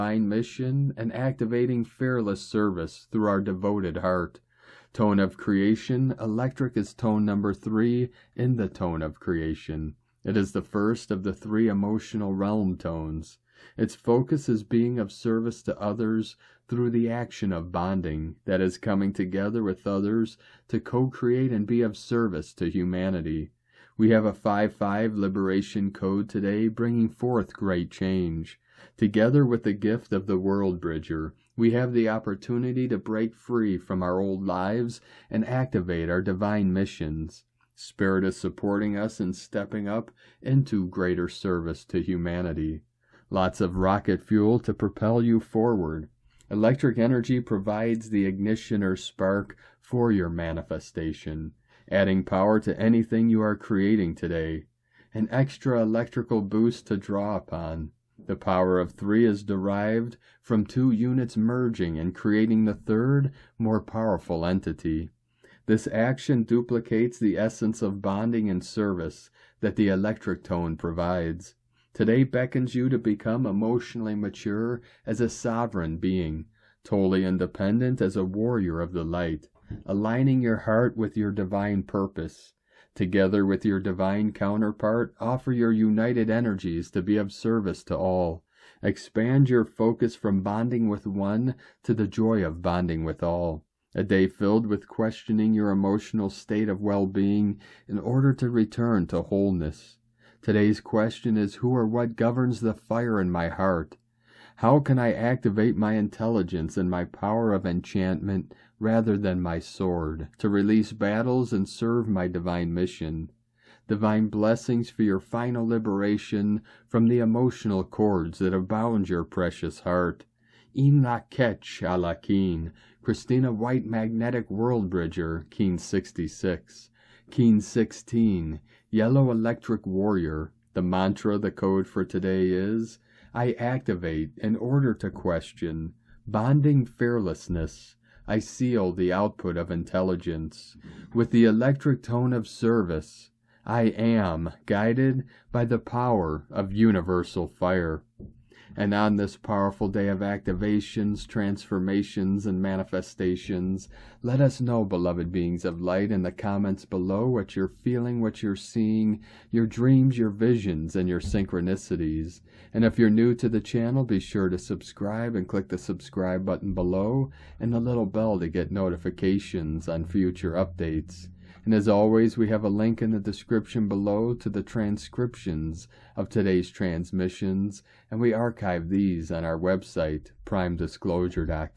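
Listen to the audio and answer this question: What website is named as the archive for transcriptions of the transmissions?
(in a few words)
primedisclosure.com.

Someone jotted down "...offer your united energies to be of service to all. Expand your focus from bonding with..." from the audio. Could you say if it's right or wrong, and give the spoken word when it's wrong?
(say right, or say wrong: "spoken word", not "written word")
right.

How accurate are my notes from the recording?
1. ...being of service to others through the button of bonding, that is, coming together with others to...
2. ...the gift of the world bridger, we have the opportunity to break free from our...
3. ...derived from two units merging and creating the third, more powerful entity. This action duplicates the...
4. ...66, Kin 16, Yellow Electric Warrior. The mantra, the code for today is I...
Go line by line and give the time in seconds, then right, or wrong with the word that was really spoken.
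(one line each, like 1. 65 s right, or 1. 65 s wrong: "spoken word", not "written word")
1. 14 s wrong: "action", not "button"
2. 29 s right
3. 59 s right
4. 125 s right.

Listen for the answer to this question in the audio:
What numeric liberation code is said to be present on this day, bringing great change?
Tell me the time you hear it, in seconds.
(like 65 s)
24 s.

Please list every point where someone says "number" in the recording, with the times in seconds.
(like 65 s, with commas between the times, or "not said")
7 s.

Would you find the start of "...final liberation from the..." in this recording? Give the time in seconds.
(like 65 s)
115 s.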